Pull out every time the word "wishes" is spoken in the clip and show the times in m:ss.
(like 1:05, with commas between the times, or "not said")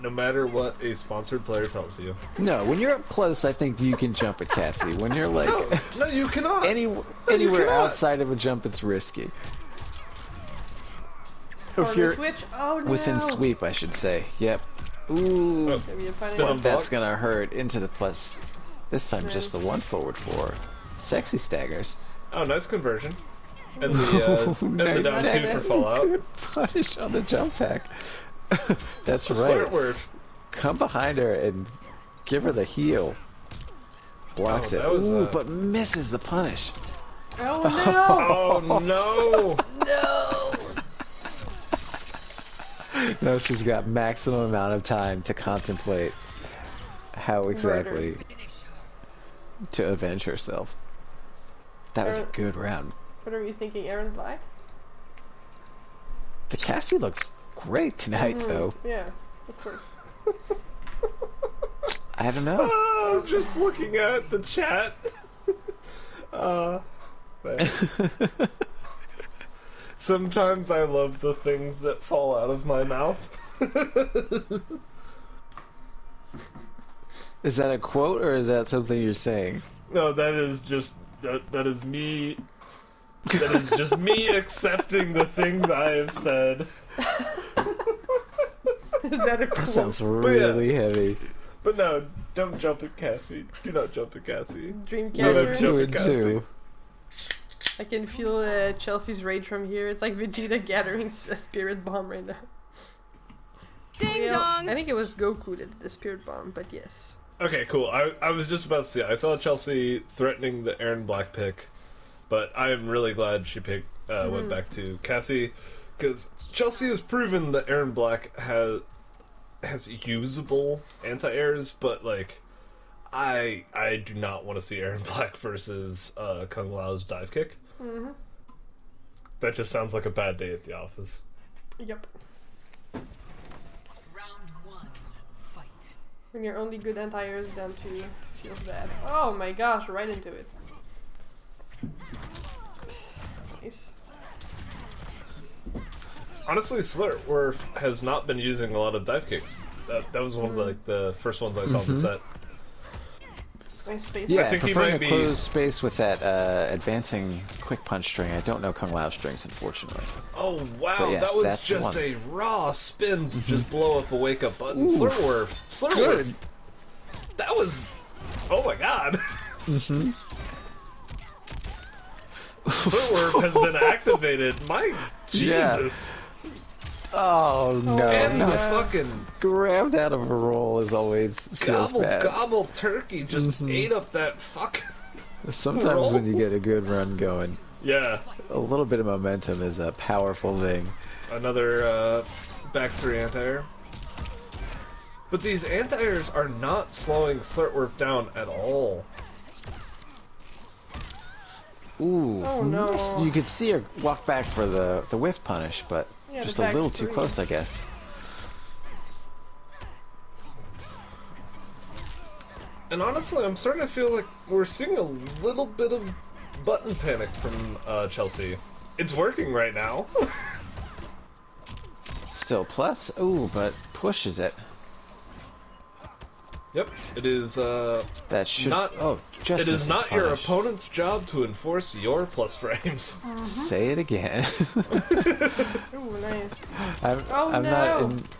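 not said.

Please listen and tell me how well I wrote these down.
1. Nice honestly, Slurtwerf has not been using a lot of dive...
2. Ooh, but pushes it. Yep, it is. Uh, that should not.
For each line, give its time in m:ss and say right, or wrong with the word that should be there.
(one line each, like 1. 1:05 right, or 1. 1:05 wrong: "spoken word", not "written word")
1. 2:23 right
2. 3:43 right.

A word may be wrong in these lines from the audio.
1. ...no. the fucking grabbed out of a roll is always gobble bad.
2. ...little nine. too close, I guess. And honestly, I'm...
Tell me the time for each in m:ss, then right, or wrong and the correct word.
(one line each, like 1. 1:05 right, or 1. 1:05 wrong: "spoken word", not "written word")
1. 2:58 right
2. 3:26 wrong: "three", not "nine".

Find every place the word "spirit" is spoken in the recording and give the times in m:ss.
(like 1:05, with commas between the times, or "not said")
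1:41, 1:45.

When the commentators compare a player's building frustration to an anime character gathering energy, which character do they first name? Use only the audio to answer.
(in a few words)
Vegeta.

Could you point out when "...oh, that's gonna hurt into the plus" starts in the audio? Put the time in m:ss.
0:15.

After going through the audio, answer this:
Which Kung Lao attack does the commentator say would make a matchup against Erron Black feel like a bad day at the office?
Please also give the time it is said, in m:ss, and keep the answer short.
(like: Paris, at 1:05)
dive kick, at 2:07.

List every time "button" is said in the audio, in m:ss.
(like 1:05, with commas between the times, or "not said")
2:44, 3:36.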